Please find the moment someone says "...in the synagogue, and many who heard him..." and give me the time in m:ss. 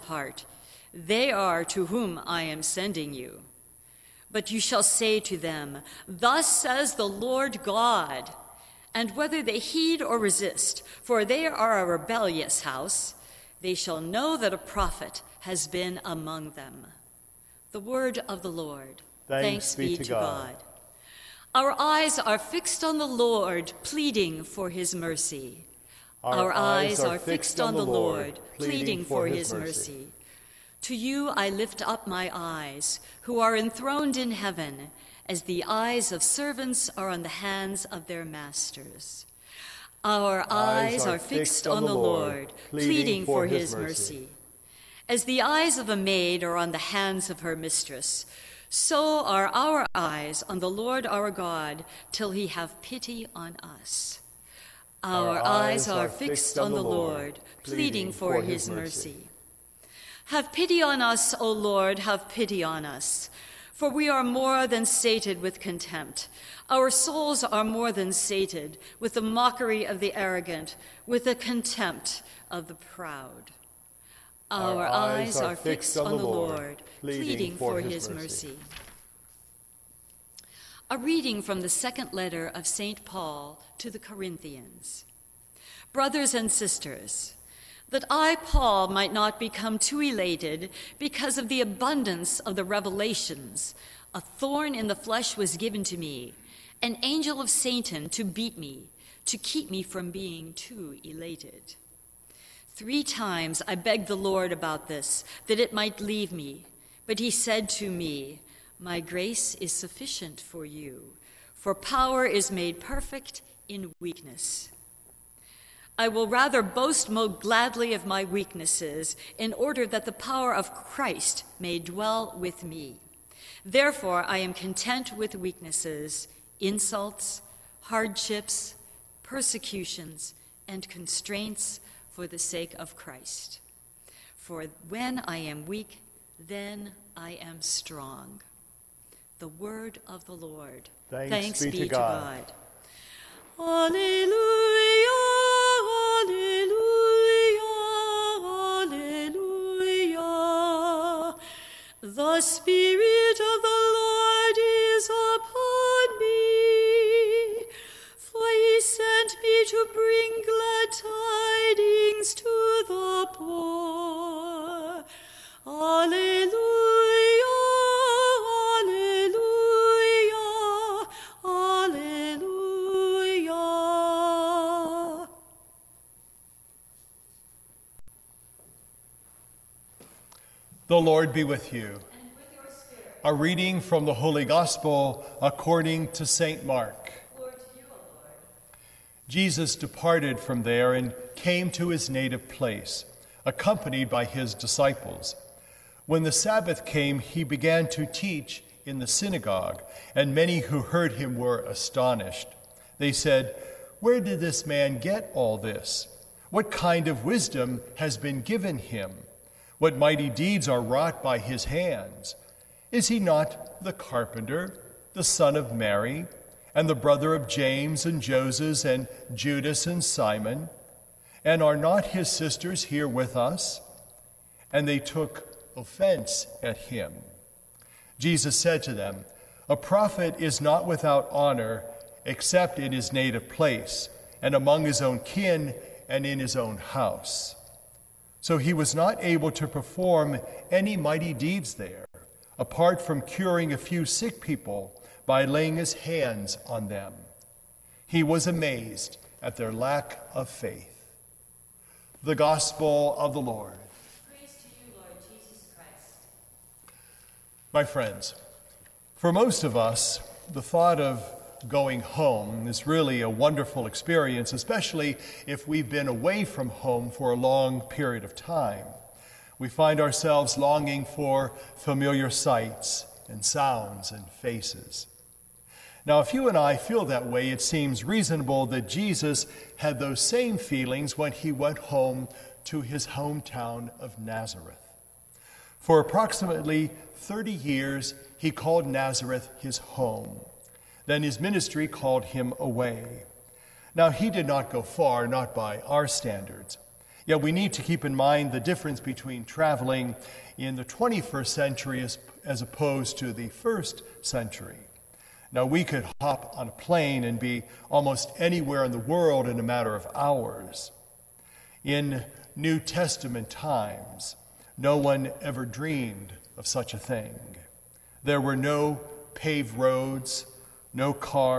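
3:18.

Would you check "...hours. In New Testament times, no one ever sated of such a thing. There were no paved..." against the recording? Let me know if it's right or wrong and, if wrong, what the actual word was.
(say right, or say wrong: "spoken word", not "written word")
wrong: "dreamed", not "sated".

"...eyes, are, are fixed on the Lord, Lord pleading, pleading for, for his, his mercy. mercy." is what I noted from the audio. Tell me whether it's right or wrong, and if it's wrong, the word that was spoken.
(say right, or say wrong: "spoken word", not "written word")
right.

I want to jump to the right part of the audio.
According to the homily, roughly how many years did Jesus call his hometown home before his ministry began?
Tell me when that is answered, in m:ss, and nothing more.
4:45.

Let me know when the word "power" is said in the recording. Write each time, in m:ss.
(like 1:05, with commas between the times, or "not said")
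1:51, 2:00.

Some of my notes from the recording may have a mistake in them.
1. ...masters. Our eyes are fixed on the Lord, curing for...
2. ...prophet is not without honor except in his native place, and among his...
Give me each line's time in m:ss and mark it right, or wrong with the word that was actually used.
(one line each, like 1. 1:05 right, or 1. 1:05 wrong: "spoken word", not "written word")
1. 0:38 wrong: "pleading", not "curing"
2. 3:49 right.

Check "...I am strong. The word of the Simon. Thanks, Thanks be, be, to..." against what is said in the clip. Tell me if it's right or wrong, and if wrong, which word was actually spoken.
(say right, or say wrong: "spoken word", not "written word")
wrong: "Lord", not "Simon".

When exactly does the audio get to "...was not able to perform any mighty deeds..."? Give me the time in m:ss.
3:58.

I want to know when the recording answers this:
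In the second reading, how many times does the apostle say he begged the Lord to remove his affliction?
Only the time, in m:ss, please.
1:42.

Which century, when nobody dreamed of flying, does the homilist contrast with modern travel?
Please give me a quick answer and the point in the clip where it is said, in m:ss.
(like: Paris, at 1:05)
first century, at 5:03.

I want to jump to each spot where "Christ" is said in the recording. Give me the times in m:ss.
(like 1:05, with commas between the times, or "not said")
2:00, 2:12.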